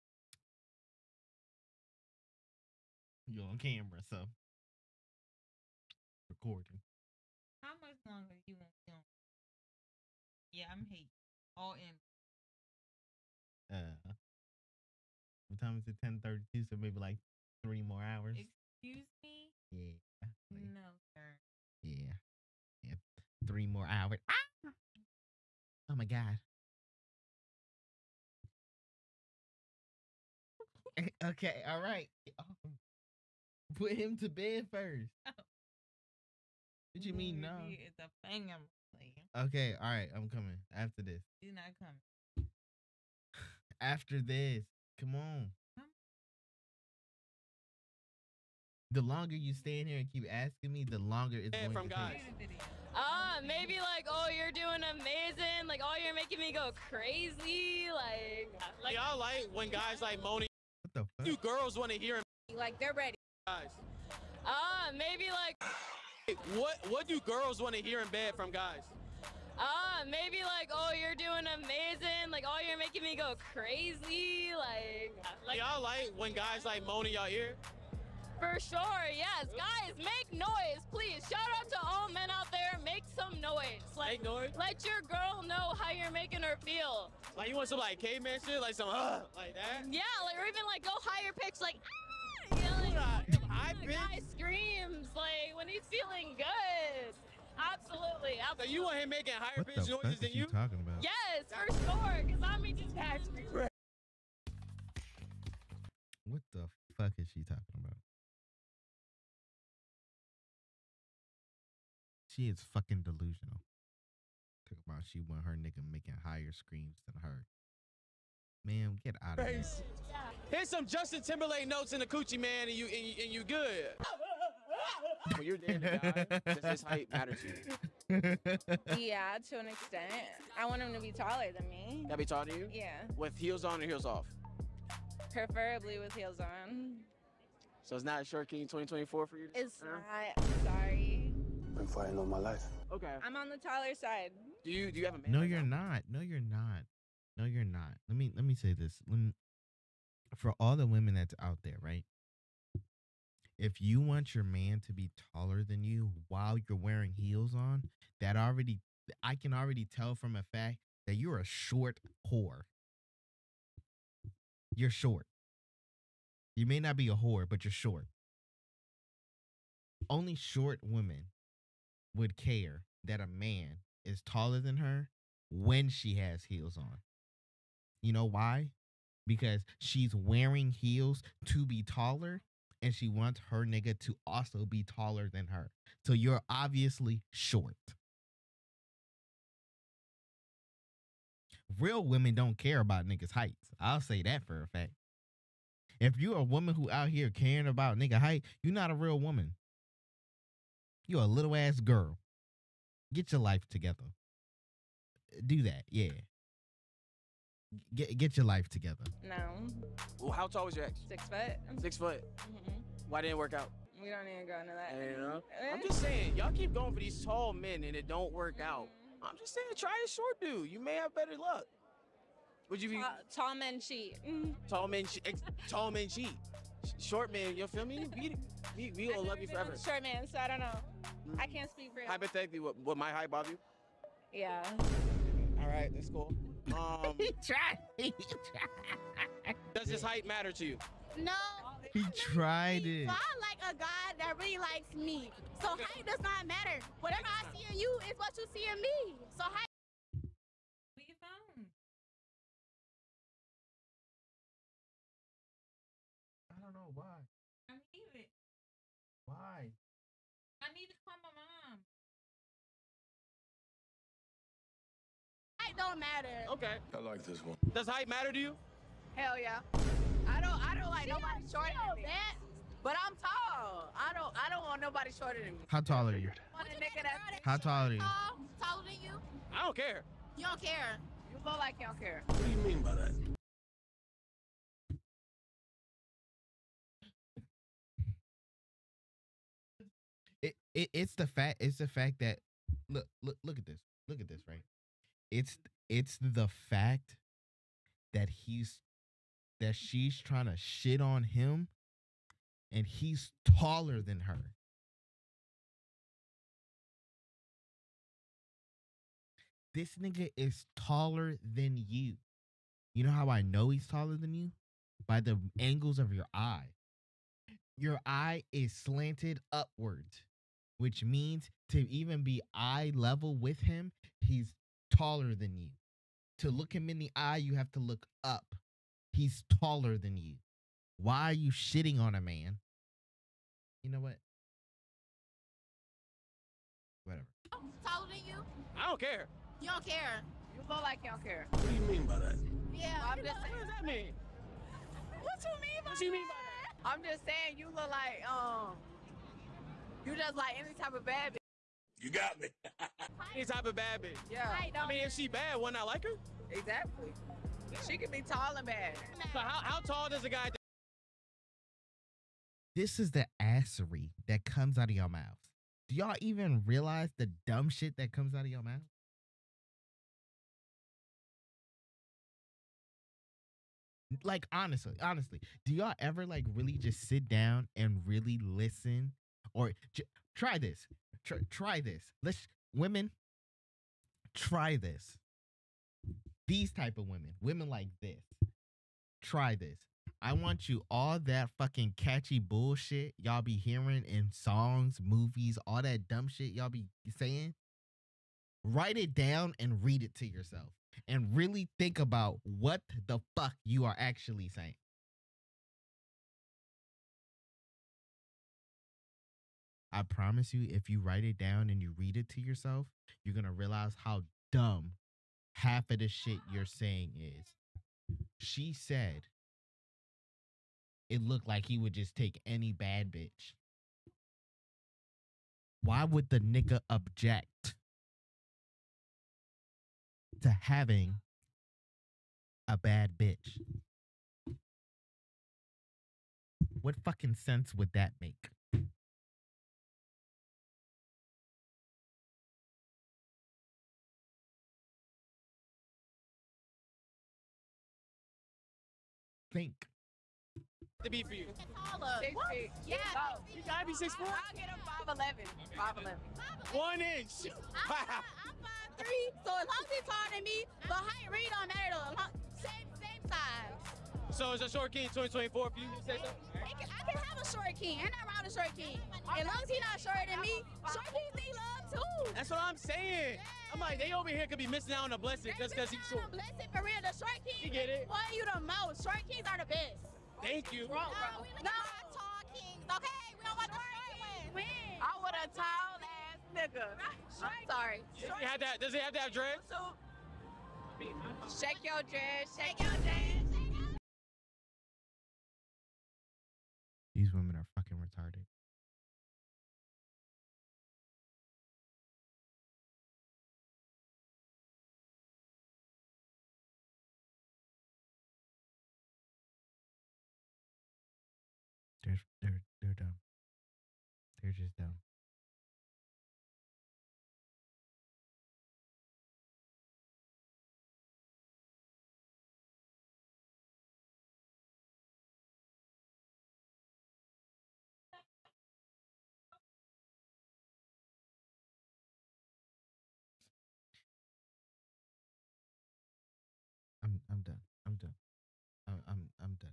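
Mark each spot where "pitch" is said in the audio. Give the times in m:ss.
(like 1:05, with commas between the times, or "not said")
1:31, 1:39.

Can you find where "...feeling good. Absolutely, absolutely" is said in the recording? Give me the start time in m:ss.
1:35.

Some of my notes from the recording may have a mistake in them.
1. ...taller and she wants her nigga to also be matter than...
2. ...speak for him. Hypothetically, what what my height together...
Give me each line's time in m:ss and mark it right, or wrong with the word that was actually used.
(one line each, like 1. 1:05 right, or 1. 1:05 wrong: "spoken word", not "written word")
1. 3:01 wrong: "taller", not "matter"
2. 3:51 wrong: "bother", not "together".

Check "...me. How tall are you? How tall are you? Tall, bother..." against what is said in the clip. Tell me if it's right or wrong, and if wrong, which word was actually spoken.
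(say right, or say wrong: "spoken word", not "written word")
wrong: "taller", not "bother".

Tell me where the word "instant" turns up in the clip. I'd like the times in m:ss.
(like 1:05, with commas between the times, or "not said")
not said.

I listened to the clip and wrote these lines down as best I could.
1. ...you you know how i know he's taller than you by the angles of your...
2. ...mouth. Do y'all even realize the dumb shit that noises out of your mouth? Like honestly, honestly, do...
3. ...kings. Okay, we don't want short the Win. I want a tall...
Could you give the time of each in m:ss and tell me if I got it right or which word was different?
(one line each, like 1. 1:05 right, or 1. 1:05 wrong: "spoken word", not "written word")
1. 5:11 right
2. 6:05 wrong: "comes", not "noises"
3. 8:02 right.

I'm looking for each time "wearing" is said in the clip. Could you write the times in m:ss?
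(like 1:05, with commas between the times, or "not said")
2:36, 3:00.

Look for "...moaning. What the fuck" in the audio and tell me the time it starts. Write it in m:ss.
1:00.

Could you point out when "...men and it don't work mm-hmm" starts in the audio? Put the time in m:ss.
3:37.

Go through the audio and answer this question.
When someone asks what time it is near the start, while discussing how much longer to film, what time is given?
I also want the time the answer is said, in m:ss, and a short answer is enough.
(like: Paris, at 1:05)
10:32, at 0:16.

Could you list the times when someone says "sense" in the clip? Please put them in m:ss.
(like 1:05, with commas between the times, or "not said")
7:17.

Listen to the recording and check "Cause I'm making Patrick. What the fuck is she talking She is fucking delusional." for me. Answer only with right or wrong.
right.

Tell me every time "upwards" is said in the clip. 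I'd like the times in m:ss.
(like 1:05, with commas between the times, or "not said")
5:19.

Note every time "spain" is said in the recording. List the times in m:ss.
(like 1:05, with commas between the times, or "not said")
not said.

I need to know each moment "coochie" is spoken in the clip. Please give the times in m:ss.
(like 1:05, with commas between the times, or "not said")
2:02.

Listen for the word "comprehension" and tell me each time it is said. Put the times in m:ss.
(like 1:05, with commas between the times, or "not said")
not said.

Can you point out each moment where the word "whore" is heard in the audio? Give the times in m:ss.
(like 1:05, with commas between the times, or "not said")
2:42, 2:47.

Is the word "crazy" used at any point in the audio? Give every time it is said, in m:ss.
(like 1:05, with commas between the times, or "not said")
0:56, 1:13.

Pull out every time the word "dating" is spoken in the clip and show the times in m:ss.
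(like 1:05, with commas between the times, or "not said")
2:05.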